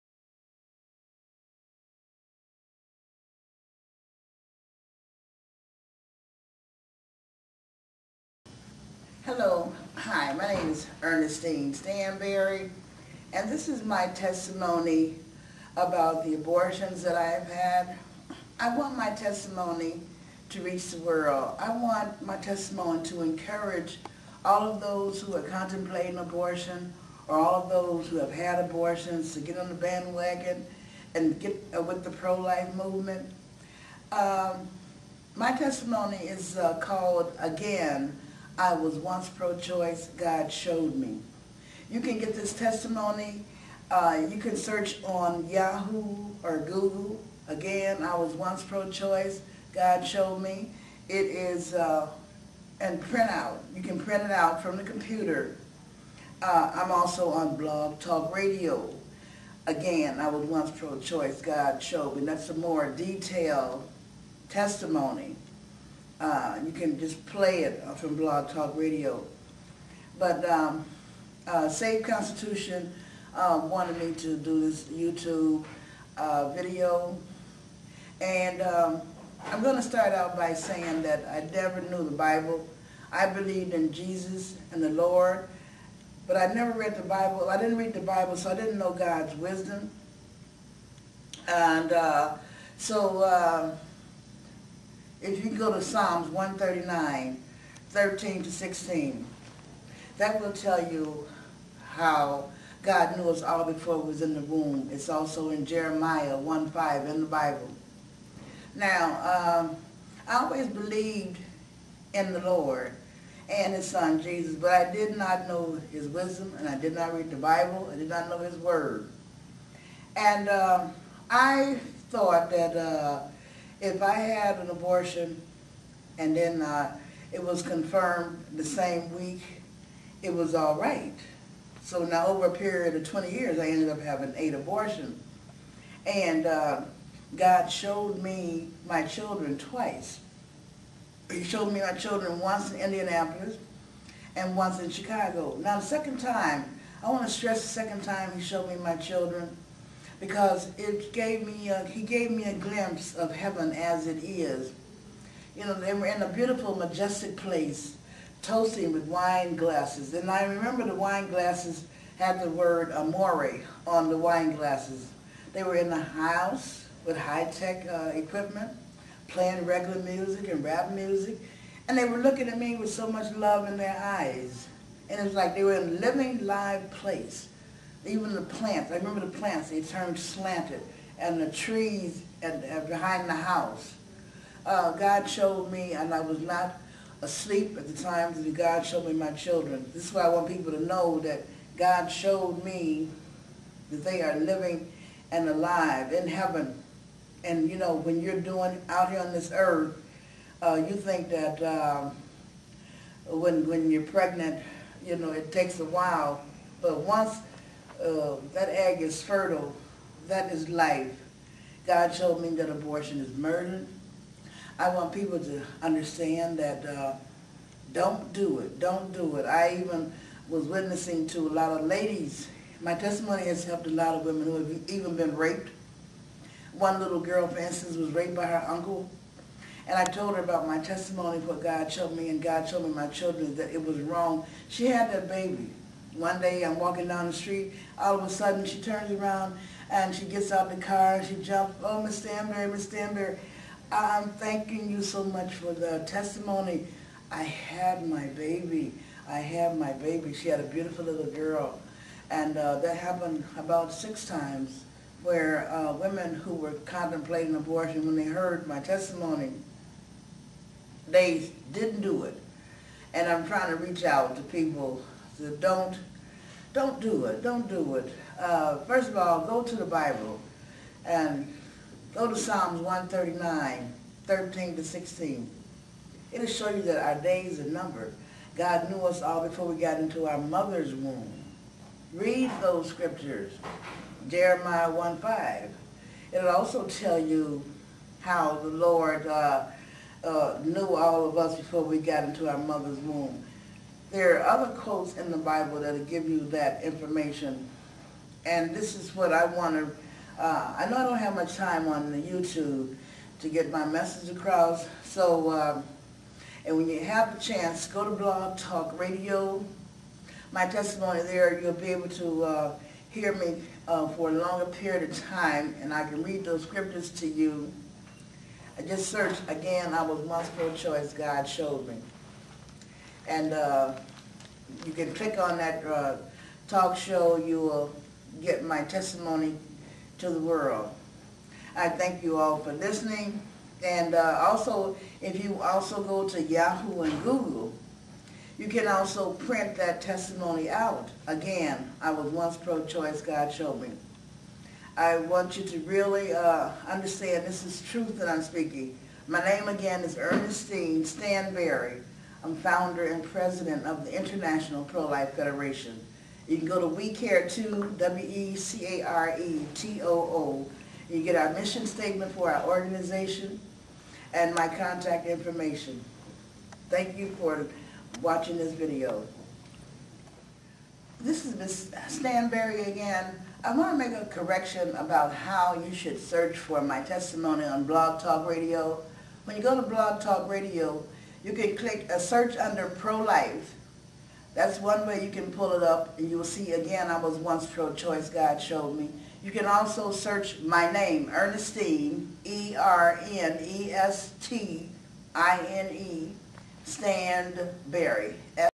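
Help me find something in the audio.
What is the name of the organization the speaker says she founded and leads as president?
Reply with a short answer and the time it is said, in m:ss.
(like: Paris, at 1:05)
International Pro-Life Federation, at 5:54.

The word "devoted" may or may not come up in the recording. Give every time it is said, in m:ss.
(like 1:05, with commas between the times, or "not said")
not said.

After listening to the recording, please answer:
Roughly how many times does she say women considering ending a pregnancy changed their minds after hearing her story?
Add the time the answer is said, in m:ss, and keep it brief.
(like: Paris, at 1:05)
6, at 4:13.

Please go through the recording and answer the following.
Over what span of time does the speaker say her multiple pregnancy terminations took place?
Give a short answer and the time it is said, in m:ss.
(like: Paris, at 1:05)
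20 years, at 2:13.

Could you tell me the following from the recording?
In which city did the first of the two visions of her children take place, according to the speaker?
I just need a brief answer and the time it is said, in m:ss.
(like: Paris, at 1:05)
Indianapolis, at 2:22.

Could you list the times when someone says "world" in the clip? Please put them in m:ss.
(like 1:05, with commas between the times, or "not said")
0:20, 5:30.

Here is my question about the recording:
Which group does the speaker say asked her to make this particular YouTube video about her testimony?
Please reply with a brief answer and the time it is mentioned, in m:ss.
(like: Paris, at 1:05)
Save Constitution, at 1:11.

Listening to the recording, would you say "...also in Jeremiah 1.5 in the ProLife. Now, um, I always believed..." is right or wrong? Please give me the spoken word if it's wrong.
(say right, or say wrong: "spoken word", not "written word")
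wrong: "Bible", not "ProLife".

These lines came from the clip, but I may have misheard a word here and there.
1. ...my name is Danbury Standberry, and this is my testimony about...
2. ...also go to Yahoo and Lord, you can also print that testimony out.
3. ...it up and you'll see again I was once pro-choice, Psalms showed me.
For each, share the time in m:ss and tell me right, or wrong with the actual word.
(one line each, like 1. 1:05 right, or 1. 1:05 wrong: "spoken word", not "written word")
1. 0:10 wrong: "Ernestine", not "Danbury"
2. 5:35 wrong: "Google", not "Lord"
3. 6:25 wrong: "God", not "Psalms".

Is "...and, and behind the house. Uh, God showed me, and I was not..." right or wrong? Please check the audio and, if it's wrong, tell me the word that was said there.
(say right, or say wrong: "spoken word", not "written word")
right.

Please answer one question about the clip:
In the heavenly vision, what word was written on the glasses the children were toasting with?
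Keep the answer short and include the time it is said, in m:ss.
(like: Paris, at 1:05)
amore, at 2:42.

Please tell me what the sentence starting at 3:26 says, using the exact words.
But once uh, that egg is fertile, that is life.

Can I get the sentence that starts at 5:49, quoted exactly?
My name again is Ernestine Standberry.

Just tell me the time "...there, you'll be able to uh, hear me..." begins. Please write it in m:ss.
5:11.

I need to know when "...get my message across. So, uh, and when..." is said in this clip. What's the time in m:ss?
5:03.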